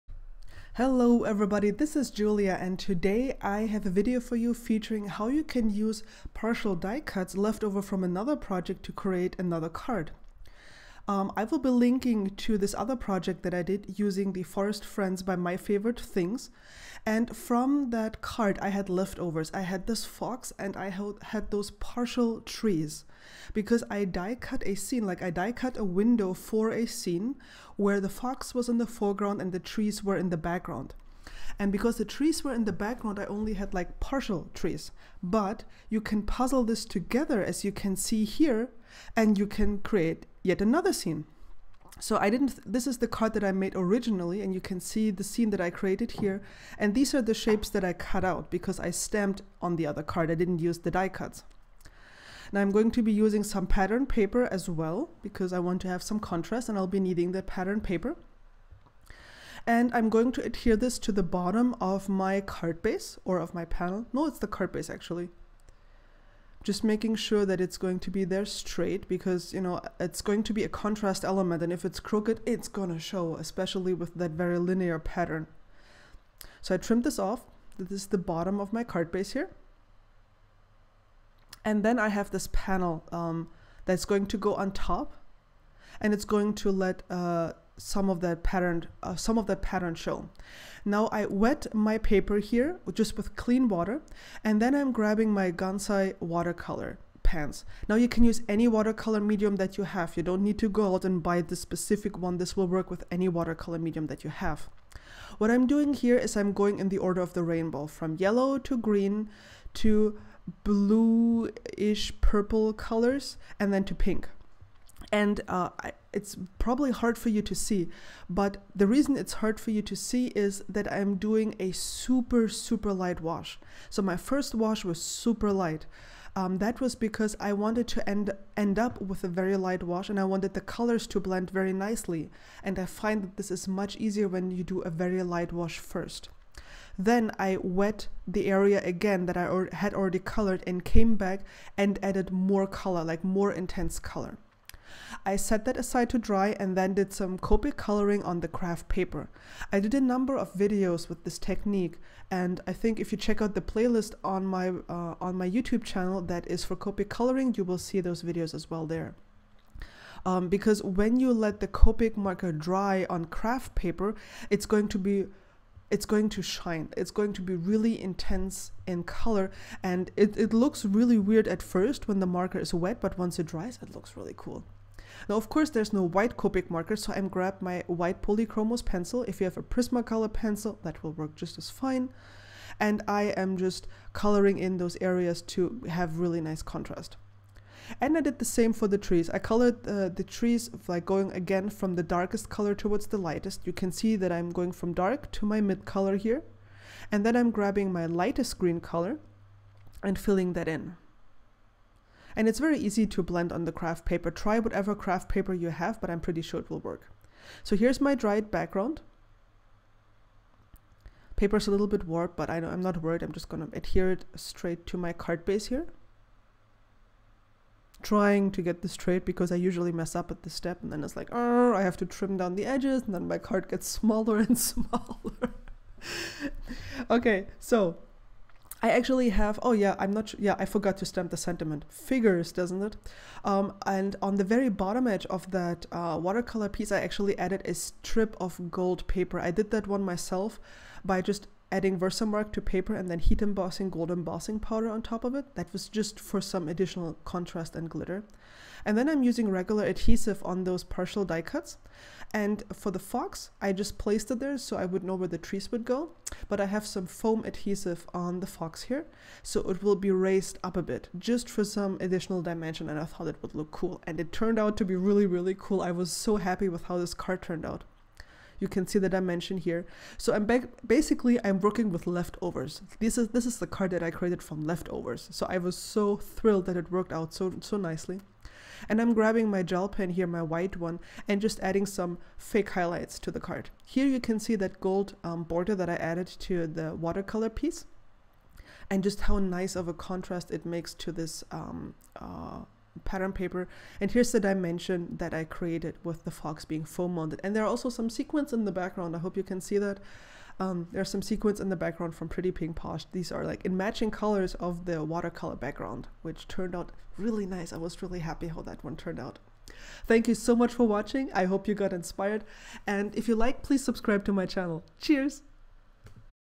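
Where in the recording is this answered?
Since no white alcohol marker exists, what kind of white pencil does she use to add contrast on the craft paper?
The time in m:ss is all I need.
2:58.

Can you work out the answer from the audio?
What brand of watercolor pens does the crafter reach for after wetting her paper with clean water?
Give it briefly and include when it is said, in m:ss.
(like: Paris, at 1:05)
Gansai, at 1:35.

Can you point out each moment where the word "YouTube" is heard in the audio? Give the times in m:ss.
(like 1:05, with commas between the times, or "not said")
2:35.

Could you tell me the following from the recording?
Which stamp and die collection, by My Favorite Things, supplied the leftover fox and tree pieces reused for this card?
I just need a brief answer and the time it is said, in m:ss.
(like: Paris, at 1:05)
Forest Friends, at 0:14.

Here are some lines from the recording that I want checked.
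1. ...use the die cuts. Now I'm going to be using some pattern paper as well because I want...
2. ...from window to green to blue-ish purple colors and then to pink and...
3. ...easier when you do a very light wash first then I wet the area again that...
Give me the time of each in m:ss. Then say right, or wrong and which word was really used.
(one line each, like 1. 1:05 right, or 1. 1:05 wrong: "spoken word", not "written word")
1. 0:50 right
2. 1:47 wrong: "yellow", not "window"
3. 2:13 right.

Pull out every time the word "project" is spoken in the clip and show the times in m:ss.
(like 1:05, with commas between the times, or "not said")
0:08, 0:12.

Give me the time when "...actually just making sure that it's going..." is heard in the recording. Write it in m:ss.
1:04.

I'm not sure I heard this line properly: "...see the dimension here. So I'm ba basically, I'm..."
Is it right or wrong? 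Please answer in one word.
right.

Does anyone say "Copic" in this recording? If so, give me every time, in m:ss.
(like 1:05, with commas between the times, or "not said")
2:27, 2:36, 2:41, 2:56.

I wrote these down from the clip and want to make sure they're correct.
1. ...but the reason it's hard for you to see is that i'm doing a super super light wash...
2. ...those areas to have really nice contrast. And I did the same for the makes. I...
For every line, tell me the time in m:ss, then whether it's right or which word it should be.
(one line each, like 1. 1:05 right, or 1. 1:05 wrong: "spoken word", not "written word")
1. 1:58 right
2. 3:04 wrong: "trees", not "makes".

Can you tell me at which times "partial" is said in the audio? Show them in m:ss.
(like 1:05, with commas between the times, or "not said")
0:06, 0:21, 0:33, 4:10.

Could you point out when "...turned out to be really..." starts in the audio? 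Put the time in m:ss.
4:24.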